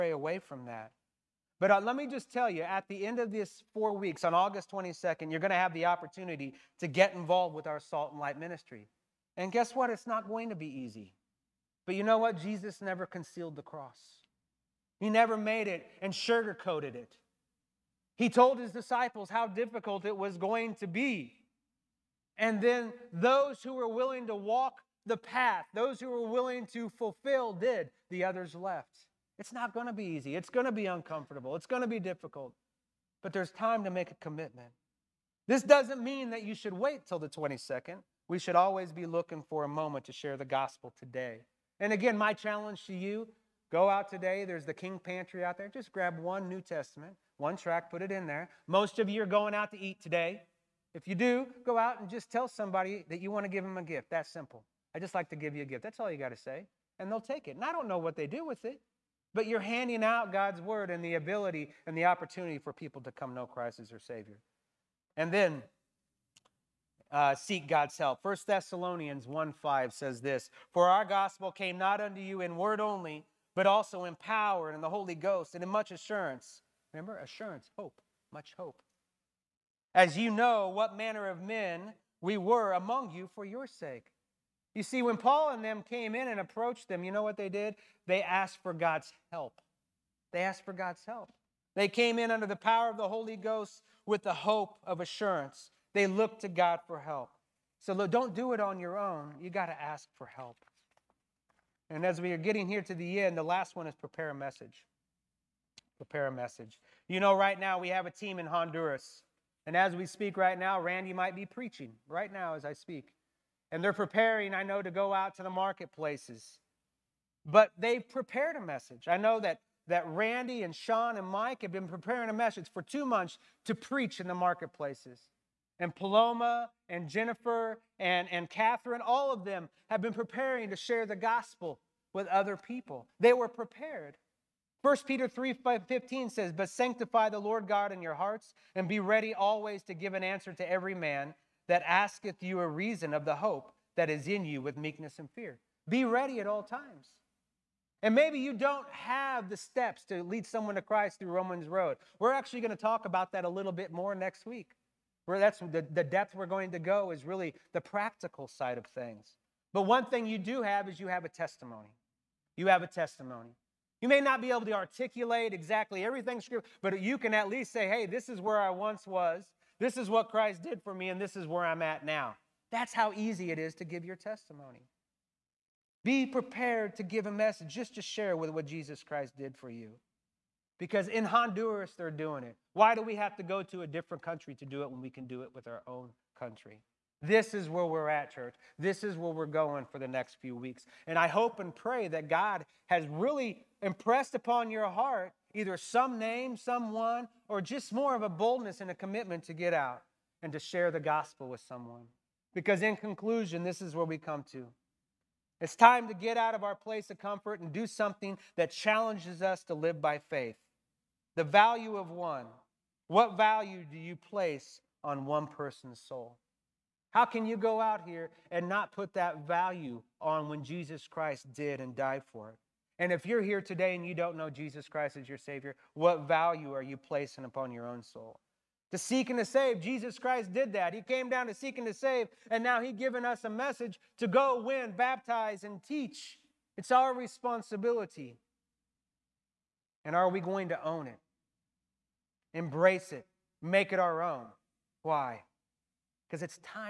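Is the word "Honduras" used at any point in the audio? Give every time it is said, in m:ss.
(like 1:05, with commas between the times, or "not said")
1:48, 3:01.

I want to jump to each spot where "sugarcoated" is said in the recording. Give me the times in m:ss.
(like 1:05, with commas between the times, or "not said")
0:16.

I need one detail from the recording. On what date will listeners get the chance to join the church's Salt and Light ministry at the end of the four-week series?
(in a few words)
August 22.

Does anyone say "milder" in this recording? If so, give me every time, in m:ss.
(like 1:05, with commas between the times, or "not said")
not said.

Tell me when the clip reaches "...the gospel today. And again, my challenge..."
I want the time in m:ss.
0:40.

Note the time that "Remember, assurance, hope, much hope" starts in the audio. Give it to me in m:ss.
1:16.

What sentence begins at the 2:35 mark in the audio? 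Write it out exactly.
Where that's the, the depth we're going to go is really the practical side of things.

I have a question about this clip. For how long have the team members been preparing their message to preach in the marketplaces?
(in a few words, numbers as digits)
2 months.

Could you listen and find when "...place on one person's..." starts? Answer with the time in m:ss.
3:34.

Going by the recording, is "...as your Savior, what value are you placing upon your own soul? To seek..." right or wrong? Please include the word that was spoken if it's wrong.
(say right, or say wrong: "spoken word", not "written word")
right.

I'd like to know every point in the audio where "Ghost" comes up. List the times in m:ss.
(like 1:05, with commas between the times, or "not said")
1:15, 1:33.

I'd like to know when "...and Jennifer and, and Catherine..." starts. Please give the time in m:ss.
2:06.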